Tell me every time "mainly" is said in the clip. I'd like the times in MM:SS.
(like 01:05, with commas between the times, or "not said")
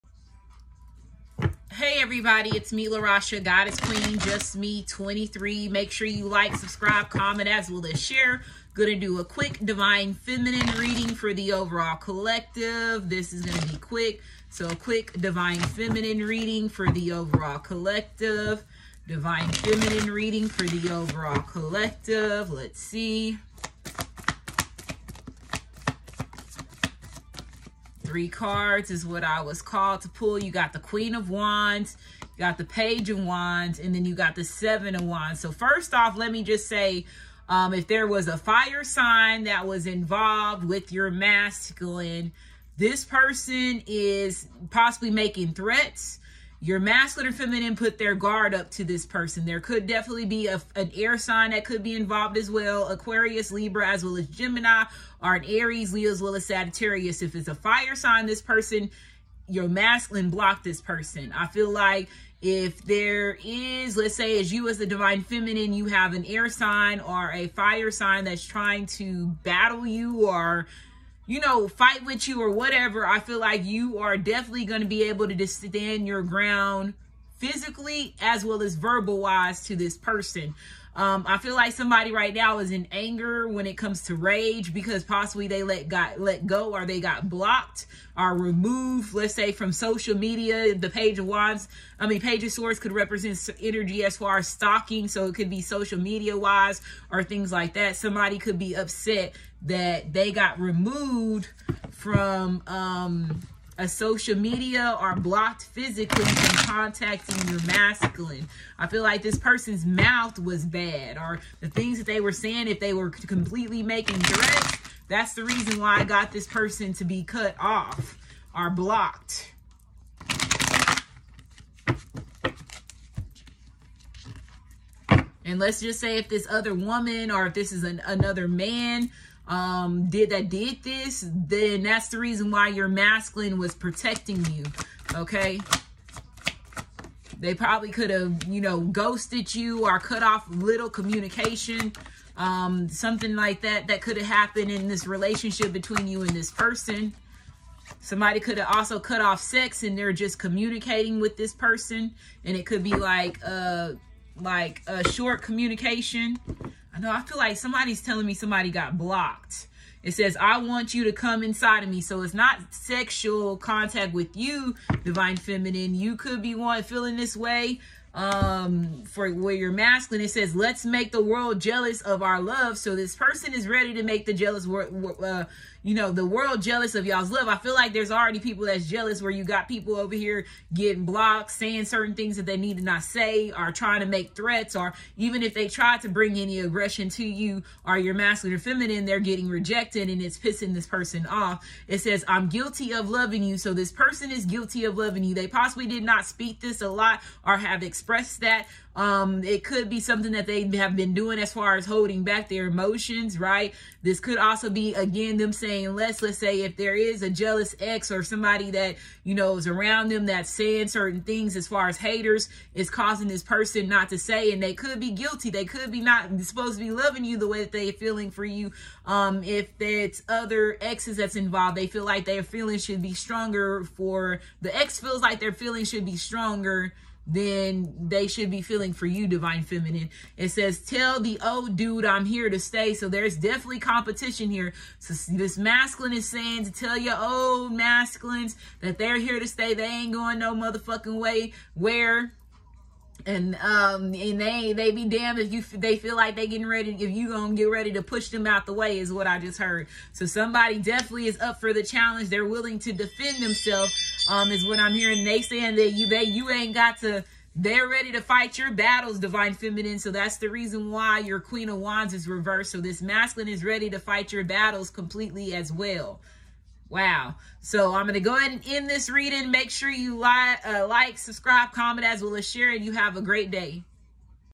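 not said.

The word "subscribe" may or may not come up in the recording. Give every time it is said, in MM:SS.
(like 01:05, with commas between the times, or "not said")
00:06, 04:31.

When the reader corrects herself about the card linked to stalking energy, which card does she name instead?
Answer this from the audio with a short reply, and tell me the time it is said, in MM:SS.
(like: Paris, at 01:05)
Page of Swords, at 01:32.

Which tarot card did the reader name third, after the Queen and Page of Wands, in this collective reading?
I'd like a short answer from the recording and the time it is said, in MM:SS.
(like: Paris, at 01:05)
Seven of Wands, at 00:34.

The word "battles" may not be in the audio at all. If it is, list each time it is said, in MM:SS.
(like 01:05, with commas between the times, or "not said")
01:09, 04:18, 04:24.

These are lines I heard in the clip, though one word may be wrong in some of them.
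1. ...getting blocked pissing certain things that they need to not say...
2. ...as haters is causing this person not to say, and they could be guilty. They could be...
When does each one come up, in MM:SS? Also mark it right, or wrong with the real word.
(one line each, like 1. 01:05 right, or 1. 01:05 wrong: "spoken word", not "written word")
1. 03:00 wrong: "saying", not "pissing"
2. 03:31 right.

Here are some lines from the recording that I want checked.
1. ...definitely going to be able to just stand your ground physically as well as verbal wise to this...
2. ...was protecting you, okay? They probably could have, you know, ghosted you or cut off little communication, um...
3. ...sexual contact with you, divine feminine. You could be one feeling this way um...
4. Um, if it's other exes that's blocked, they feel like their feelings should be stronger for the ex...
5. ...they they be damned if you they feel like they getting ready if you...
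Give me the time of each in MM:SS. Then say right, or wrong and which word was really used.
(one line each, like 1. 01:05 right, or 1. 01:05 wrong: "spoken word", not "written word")
1. 01:14 right
2. 02:13 right
3. 02:42 right
4. 03:39 wrong: "involved", not "blocked"
5. 04:04 right.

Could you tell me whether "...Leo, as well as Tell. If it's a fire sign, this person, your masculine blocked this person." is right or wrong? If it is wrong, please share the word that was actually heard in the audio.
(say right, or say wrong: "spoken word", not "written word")
wrong: "Sagittarius", not "Tell".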